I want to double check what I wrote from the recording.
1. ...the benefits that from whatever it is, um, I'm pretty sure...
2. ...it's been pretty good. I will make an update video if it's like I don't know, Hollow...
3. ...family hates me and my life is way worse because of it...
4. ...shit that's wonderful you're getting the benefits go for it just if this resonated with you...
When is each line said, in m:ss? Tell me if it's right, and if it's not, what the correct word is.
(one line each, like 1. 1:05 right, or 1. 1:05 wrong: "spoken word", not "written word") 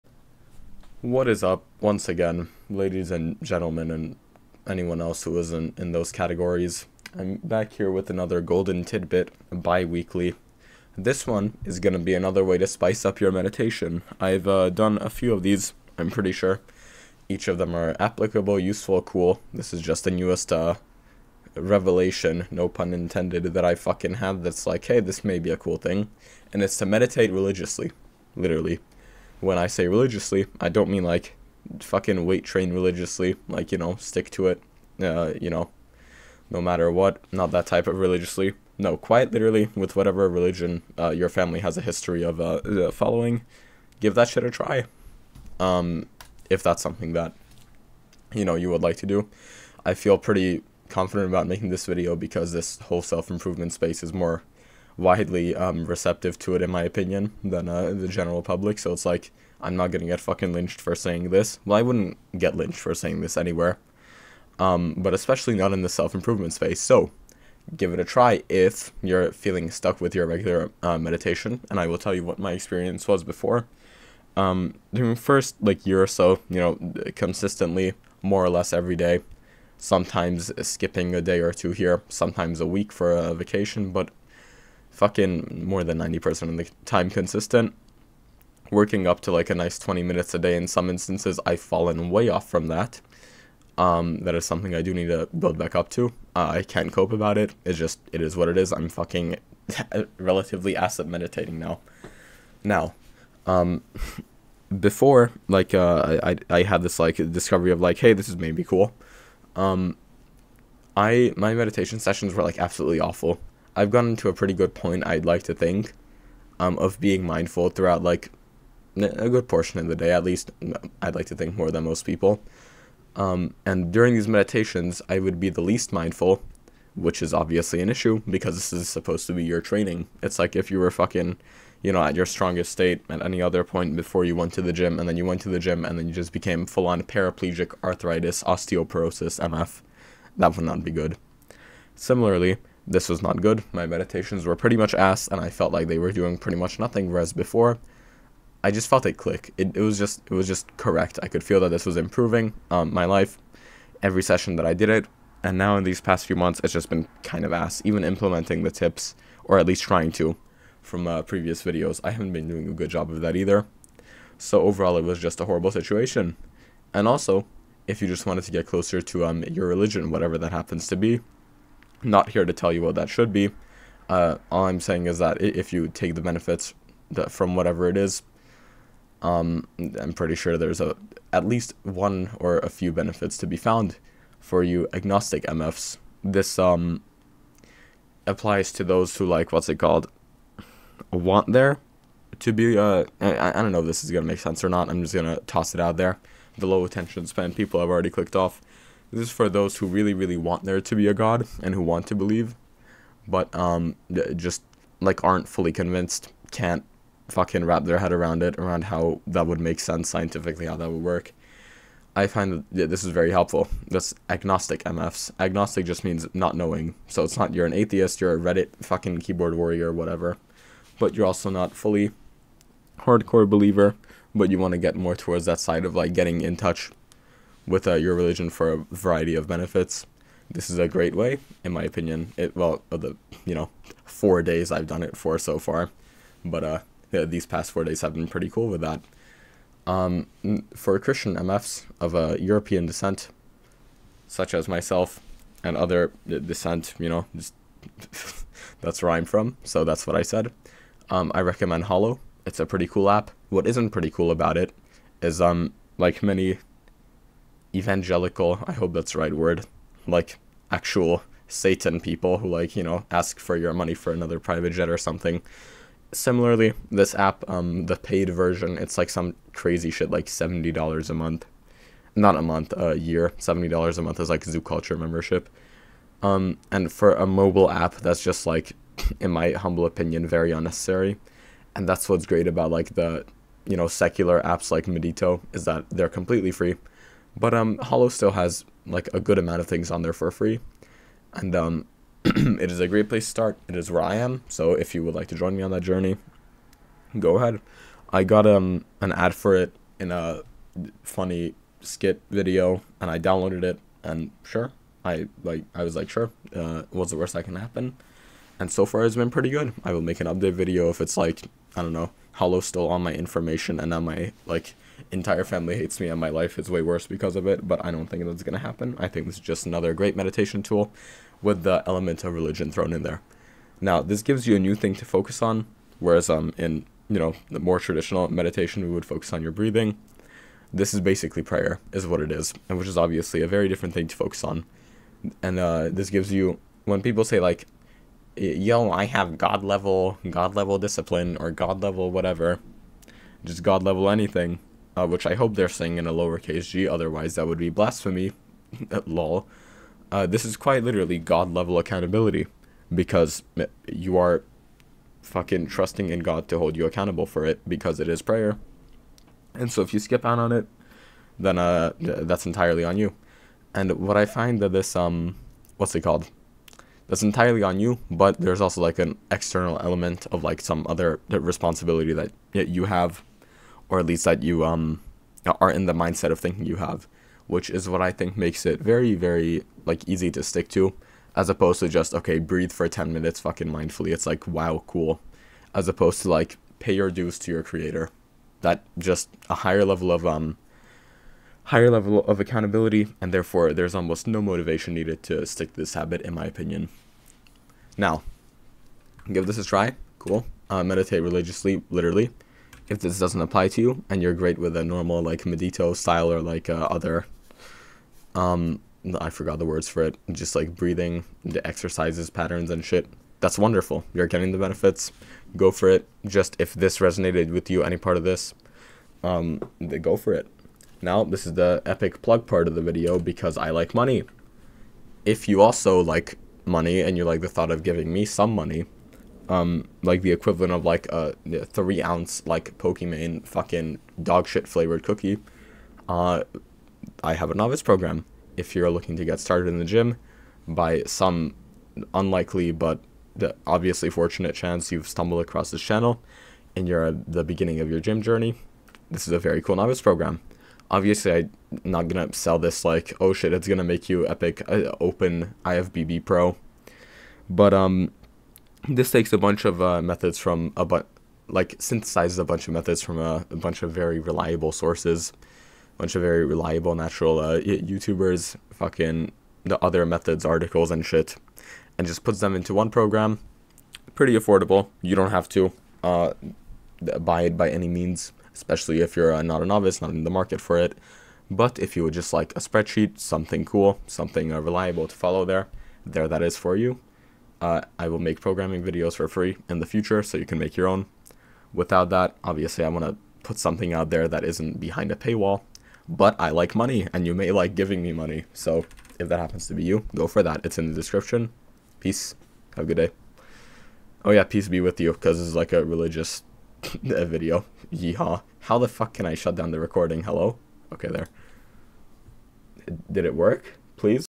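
1. 2:56 right
2. 5:09 right
3. 5:15 right
4. 6:52 right.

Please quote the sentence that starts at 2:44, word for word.
So overall, it was just a horrible situation.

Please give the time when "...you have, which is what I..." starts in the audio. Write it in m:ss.
6:16.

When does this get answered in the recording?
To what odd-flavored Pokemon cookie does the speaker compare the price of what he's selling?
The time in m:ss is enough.
7:14.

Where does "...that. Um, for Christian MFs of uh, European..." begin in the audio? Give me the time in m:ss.
3:58.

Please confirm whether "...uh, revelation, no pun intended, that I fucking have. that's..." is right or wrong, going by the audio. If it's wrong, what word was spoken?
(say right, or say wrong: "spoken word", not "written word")
right.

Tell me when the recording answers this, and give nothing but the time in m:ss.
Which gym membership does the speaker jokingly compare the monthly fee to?
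4:34.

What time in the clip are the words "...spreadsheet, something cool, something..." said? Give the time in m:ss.
8:02.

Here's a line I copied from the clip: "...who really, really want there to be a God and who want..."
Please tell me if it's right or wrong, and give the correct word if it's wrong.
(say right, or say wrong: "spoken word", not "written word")
right.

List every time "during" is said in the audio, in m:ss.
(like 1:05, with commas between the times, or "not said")
1:14, 2:03.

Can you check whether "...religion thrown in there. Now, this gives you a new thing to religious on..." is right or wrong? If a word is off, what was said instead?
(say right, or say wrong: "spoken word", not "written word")
wrong: "focus", not "religious".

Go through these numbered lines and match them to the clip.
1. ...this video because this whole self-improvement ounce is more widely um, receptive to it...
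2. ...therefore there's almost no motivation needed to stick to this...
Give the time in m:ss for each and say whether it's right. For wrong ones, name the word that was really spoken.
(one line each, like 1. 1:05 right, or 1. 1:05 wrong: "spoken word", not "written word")
1. 0:51 wrong: "space", not "ounce"
2. 6:33 right.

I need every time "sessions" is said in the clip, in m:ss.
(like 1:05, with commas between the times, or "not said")
1:51, 2:34.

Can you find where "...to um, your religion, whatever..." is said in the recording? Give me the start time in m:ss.
2:49.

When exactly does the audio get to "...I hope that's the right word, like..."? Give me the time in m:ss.
4:18.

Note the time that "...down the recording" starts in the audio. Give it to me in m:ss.
8:29.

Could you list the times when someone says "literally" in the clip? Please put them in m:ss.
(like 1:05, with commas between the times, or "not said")
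0:28, 0:39, 5:50, 6:41.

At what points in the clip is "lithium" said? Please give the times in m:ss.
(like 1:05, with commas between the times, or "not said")
not said.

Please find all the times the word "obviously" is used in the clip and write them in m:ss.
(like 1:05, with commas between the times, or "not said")
2:07, 5:32, 7:23, 7:30, 8:12.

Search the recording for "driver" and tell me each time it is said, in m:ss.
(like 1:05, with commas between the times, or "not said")
not said.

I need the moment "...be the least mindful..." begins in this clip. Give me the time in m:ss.
2:05.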